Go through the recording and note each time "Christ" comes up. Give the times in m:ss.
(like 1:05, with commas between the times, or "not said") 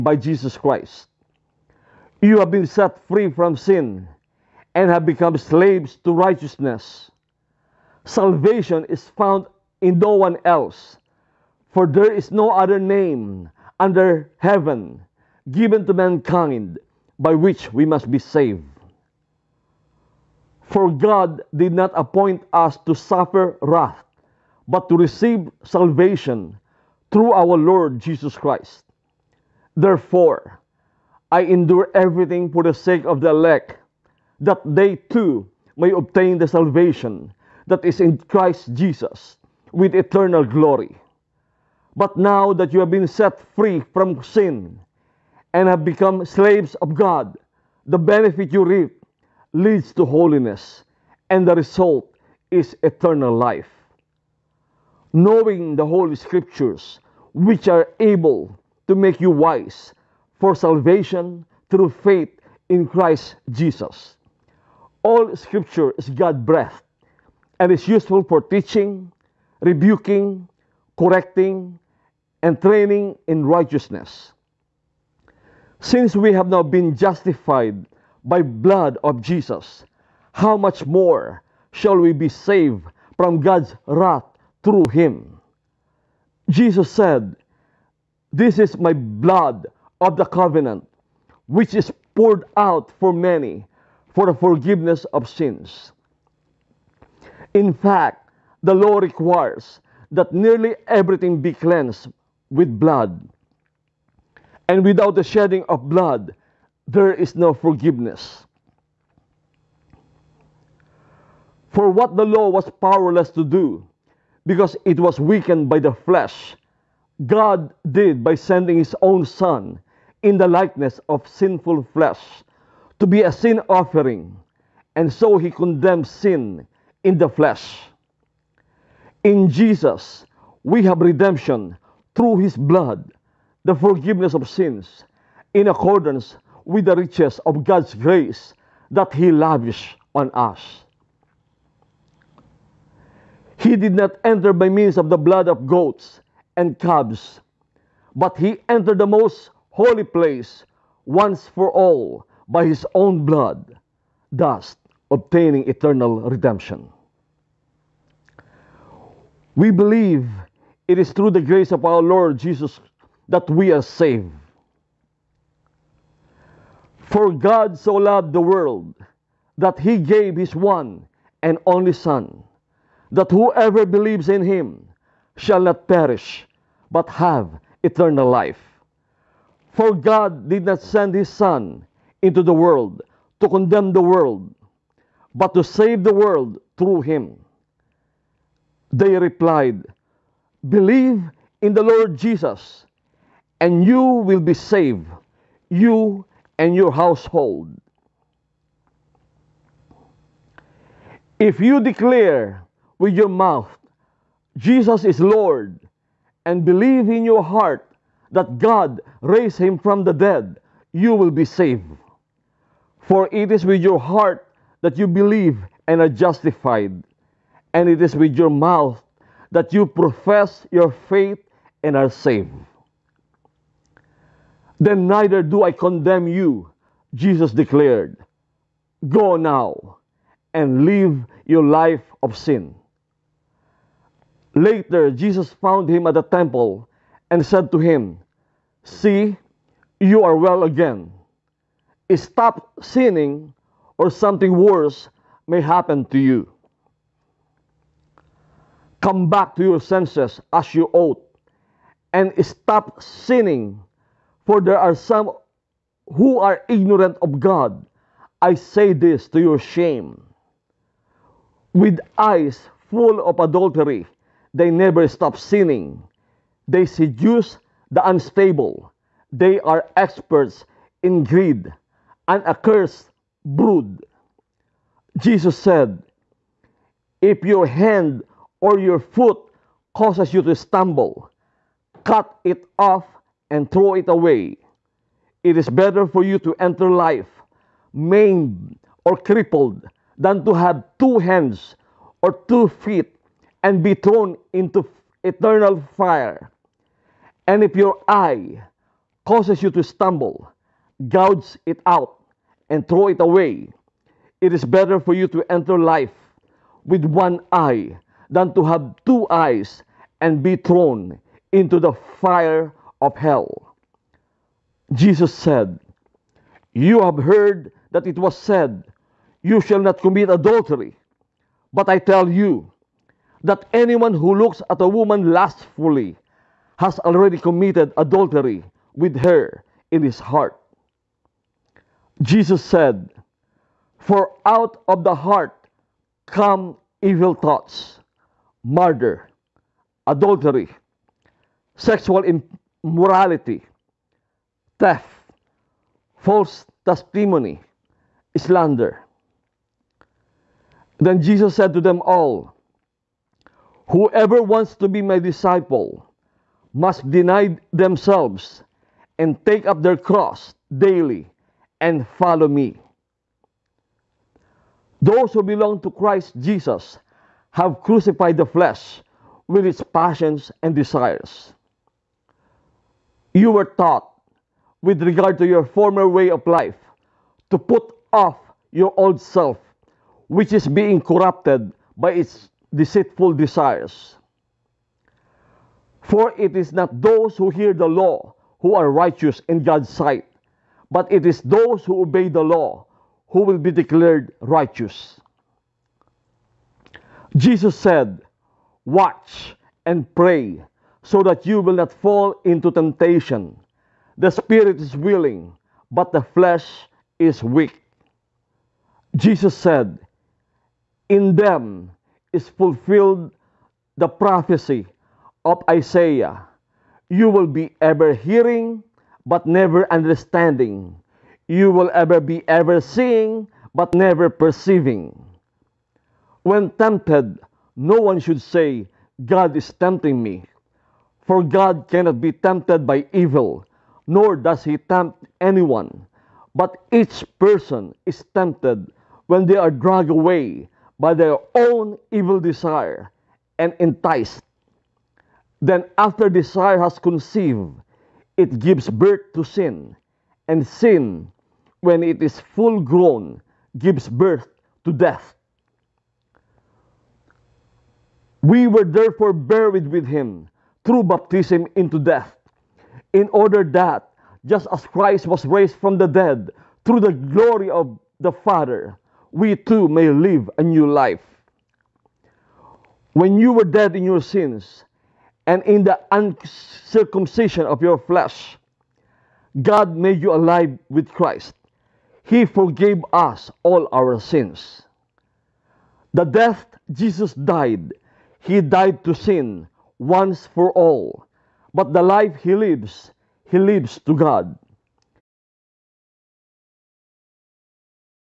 0:00, 0:28, 0:38, 1:02, 6:05, 7:44, 8:01.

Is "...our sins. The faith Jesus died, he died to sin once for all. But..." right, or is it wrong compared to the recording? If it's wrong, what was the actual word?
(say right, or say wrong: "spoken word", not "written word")
wrong: "death", not "faith".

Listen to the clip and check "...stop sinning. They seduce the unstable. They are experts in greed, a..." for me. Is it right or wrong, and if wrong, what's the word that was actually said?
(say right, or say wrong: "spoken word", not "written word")
right.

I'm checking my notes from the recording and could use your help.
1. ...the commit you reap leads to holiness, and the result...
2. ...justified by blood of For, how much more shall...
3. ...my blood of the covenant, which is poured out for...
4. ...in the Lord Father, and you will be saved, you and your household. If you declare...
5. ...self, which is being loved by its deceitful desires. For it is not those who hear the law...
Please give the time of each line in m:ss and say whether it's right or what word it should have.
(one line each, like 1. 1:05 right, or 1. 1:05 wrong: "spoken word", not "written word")
1. 0:47 wrong: "benefit", not "commit"
2. 1:16 wrong: "Jesus", not "For"
3. 1:28 right
4. 3:11 wrong: "Jesus", not "Father"
5. 6:19 wrong: "corrupted", not "loved".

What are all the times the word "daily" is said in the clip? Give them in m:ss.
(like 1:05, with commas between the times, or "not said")
6:00.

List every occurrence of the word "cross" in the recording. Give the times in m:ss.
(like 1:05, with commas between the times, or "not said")
5:59.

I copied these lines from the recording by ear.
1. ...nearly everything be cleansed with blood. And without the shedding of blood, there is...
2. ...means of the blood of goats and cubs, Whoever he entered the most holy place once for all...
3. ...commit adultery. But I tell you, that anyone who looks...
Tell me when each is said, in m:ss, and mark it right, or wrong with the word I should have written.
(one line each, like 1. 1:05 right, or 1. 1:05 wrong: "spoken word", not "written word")
1. 1:40 right
2. 2:24 wrong: "But", not "Whoever"
3. 5:19 right.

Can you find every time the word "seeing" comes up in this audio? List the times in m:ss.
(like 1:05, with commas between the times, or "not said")
7:02.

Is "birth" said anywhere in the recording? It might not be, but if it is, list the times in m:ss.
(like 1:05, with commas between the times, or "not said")
7:28, 7:34.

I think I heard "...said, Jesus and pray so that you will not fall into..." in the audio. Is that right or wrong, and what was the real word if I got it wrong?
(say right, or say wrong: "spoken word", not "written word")
wrong: "Watch", not "Jesus".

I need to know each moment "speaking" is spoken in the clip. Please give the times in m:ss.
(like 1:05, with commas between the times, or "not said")
not said.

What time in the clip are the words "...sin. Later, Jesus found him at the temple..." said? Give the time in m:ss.
3:52.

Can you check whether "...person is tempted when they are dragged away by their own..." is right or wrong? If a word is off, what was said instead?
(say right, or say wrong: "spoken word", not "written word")
right.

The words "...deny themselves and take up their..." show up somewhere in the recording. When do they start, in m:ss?
5:57.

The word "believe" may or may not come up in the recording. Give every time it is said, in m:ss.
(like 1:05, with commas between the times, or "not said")
2:39, 2:53, 3:10, 3:26, 3:35.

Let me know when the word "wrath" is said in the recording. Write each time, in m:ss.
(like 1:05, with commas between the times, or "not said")
0:23, 1:23.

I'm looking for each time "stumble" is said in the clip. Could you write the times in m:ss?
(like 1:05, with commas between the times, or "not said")
4:40, 4:59.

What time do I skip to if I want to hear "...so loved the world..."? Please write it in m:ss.
2:47.